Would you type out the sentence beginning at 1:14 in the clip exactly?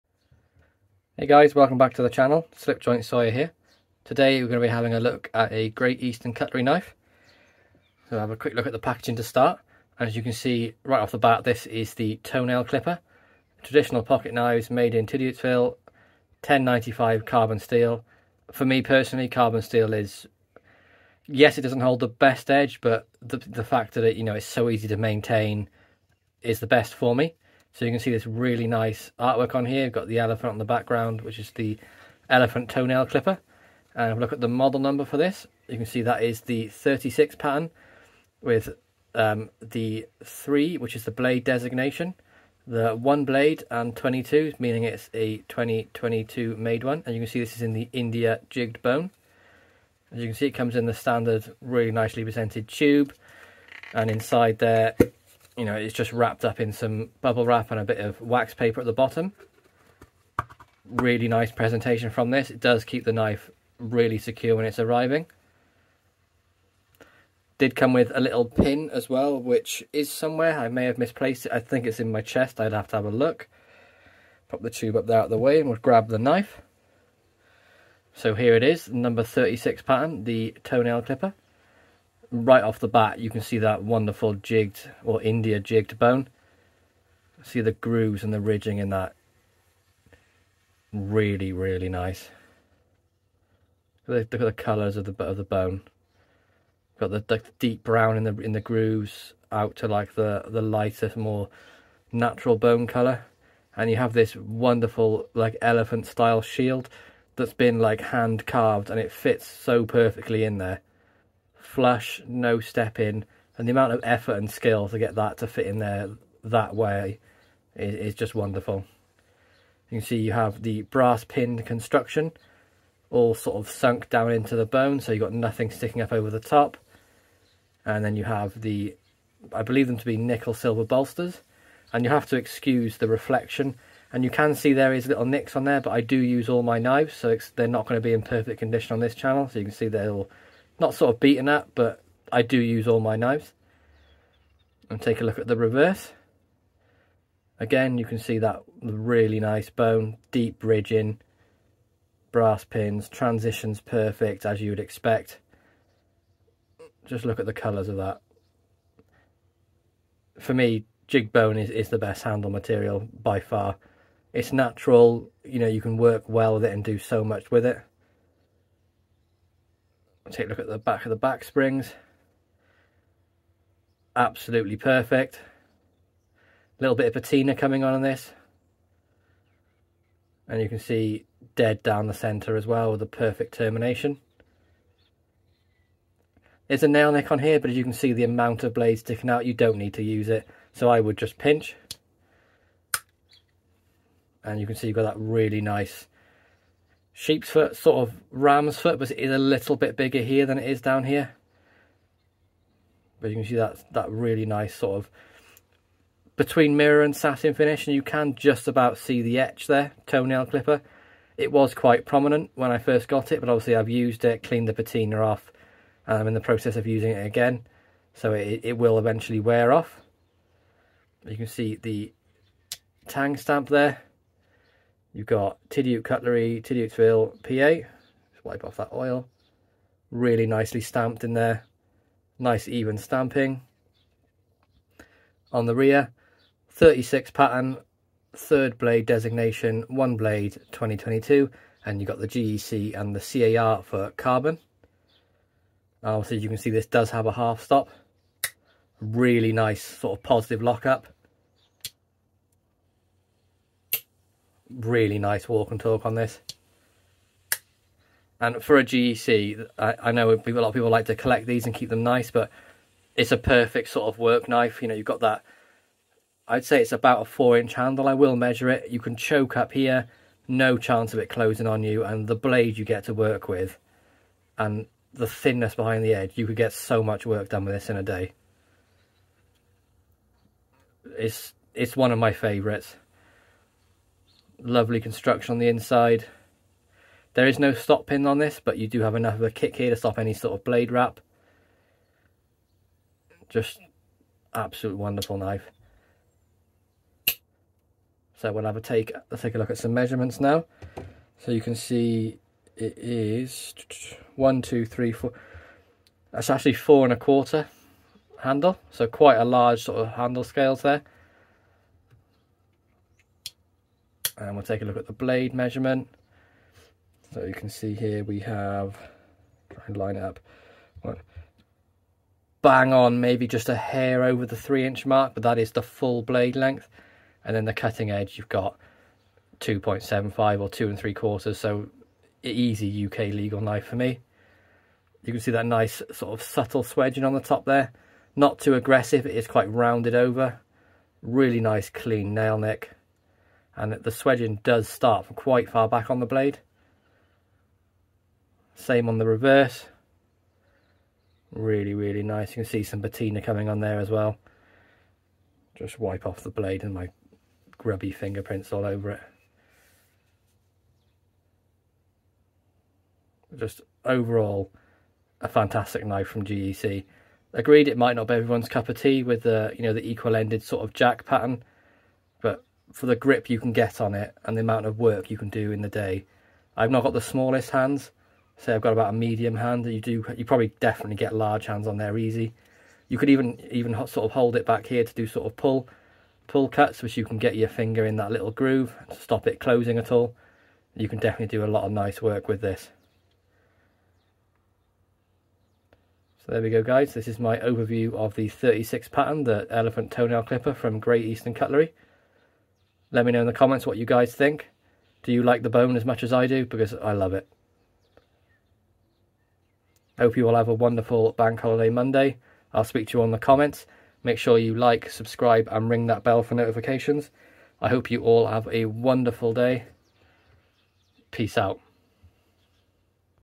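Pop the tube up there out of the way and we'll grab the knife.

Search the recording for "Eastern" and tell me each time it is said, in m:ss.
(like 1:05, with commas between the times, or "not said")
0:06, 6:41.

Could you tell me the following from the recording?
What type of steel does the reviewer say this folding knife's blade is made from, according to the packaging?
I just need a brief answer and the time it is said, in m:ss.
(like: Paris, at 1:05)
1095 carbon steel, at 0:16.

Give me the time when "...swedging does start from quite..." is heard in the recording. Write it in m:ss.
5:44.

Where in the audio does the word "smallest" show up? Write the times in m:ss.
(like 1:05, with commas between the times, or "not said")
6:17.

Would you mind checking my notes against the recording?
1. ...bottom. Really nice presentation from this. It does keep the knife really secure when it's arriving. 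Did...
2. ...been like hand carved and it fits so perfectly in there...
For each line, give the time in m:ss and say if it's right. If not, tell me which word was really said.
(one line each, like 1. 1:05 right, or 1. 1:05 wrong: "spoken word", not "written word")
1. 0:58 right
2. 1:47 right.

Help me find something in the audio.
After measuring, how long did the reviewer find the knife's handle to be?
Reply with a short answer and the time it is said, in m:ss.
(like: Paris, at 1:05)
4 and a quarter inches, at 5:06.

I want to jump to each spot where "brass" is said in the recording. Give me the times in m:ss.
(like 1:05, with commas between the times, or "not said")
2:00, 2:32.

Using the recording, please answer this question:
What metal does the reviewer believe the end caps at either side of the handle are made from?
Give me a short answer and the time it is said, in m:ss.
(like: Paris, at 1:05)
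nickel silver, at 2:10.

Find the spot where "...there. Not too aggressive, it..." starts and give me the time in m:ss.
5:37.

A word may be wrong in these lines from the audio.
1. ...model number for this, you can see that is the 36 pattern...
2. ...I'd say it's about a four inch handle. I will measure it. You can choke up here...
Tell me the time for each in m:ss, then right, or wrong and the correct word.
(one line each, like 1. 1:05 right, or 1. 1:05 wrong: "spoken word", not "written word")
1. 0:34 right
2. 4:26 right.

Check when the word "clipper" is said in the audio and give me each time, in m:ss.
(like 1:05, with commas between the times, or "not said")
0:12, 0:33, 1:21, 3:30, 6:40.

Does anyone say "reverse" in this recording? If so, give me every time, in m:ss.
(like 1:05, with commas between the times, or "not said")
2:25, 5:49.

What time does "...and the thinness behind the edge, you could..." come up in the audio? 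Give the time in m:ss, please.
4:34.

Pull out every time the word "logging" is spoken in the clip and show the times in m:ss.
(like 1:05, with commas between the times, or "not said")
not said.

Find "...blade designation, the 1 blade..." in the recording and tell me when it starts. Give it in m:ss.
0:41.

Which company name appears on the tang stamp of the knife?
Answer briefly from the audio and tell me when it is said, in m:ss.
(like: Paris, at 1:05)
Tidioute Cutlery, at 3:45.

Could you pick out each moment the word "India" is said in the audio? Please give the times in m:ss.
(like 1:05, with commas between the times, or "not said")
0:47, 1:25.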